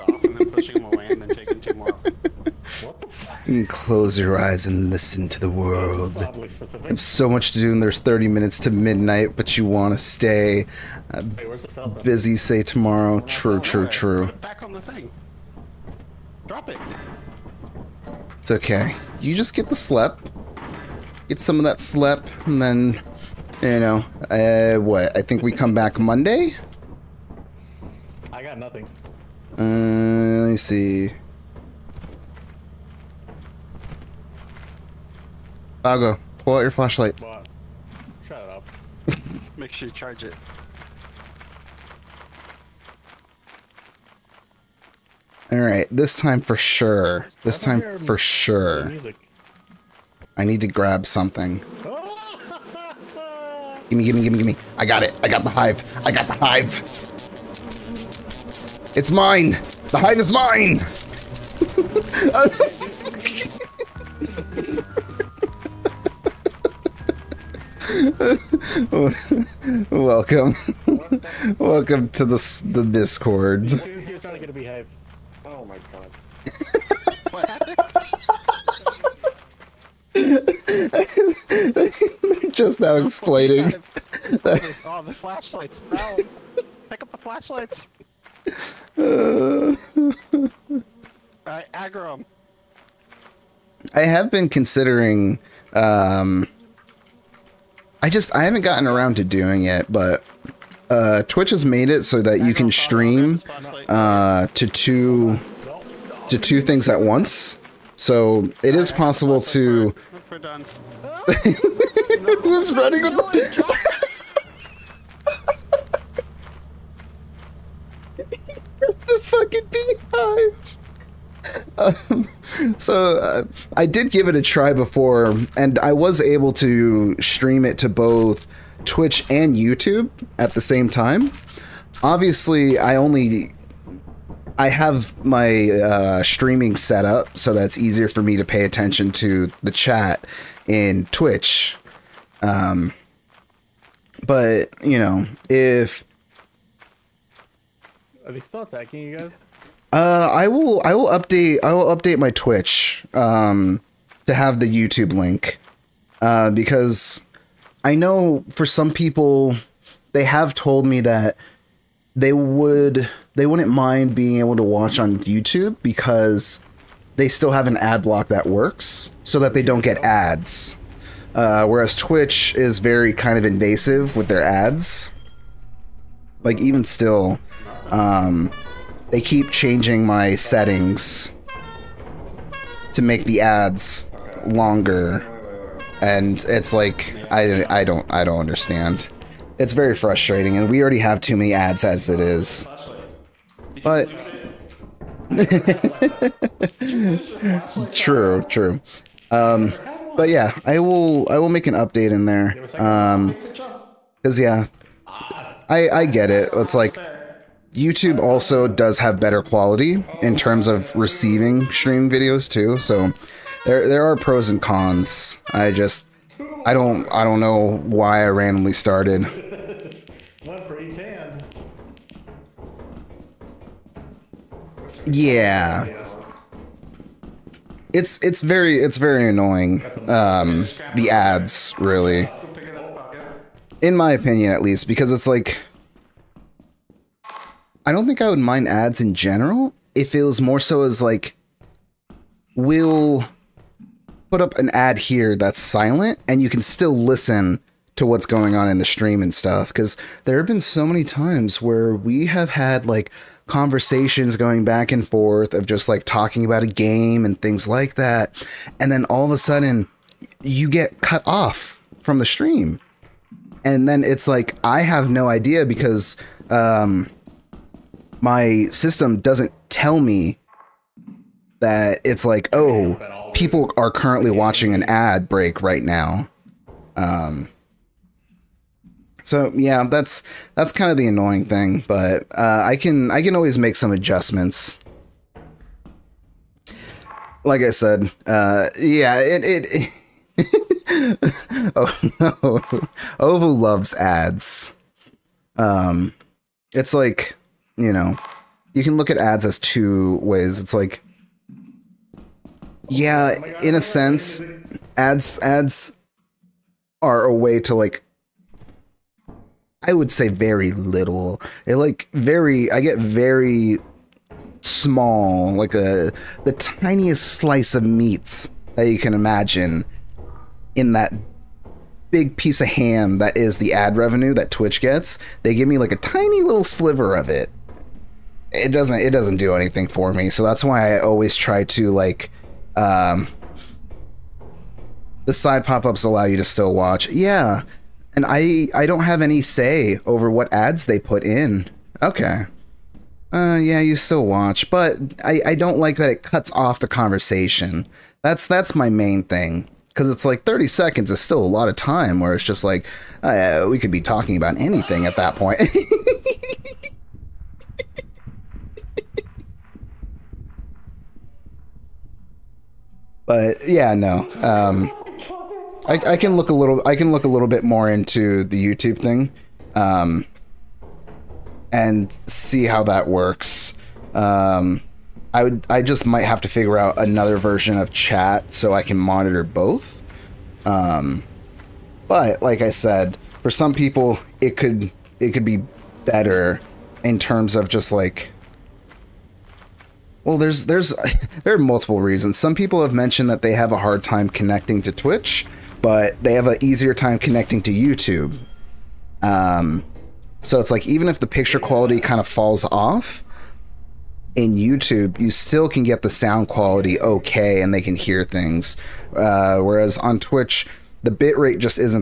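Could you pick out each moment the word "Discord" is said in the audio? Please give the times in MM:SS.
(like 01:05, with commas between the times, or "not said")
01:12.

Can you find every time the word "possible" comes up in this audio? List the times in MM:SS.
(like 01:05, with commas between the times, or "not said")
01:48.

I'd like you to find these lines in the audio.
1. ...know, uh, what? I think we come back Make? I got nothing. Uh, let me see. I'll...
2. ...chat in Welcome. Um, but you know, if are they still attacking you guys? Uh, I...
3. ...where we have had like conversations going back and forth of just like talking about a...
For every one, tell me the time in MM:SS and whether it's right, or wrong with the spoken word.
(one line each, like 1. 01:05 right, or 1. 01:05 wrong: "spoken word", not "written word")
1. 00:23 wrong: "Monday", not "Make"
2. 02:19 wrong: "Twitch", not "Welcome"
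3. 04:11 right.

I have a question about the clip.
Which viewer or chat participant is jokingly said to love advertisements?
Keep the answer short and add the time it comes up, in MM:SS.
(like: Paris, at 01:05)
Ovo, at 04:53.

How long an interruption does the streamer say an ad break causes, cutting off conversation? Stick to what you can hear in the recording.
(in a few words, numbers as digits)
30 seconds.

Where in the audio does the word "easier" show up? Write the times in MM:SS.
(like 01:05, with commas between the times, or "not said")
02:17, 06:36.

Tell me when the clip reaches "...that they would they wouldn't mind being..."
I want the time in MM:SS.
02:40.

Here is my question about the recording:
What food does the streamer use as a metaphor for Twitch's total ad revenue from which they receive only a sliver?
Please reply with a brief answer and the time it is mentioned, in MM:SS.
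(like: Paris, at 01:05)
ham, at 05:22.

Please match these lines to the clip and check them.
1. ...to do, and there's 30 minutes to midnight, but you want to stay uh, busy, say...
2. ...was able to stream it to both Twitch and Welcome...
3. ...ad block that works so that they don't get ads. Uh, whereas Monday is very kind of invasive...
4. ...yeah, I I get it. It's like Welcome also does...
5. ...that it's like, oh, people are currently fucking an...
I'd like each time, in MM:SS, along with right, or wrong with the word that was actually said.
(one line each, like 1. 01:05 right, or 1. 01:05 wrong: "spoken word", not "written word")
1. 00:07 right
2. 02:05 wrong: "YouTube", not "Welcome"
3. 02:47 wrong: "Twitch", not "Monday"
4. 03:24 wrong: "YouTube", not "Welcome"
5. 04:31 wrong: "watching", not "fucking".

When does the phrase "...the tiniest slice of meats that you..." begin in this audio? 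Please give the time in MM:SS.
05:16.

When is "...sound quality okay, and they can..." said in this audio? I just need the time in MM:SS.
06:46.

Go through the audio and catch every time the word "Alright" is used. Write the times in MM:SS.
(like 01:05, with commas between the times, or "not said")
00:45, 01:31.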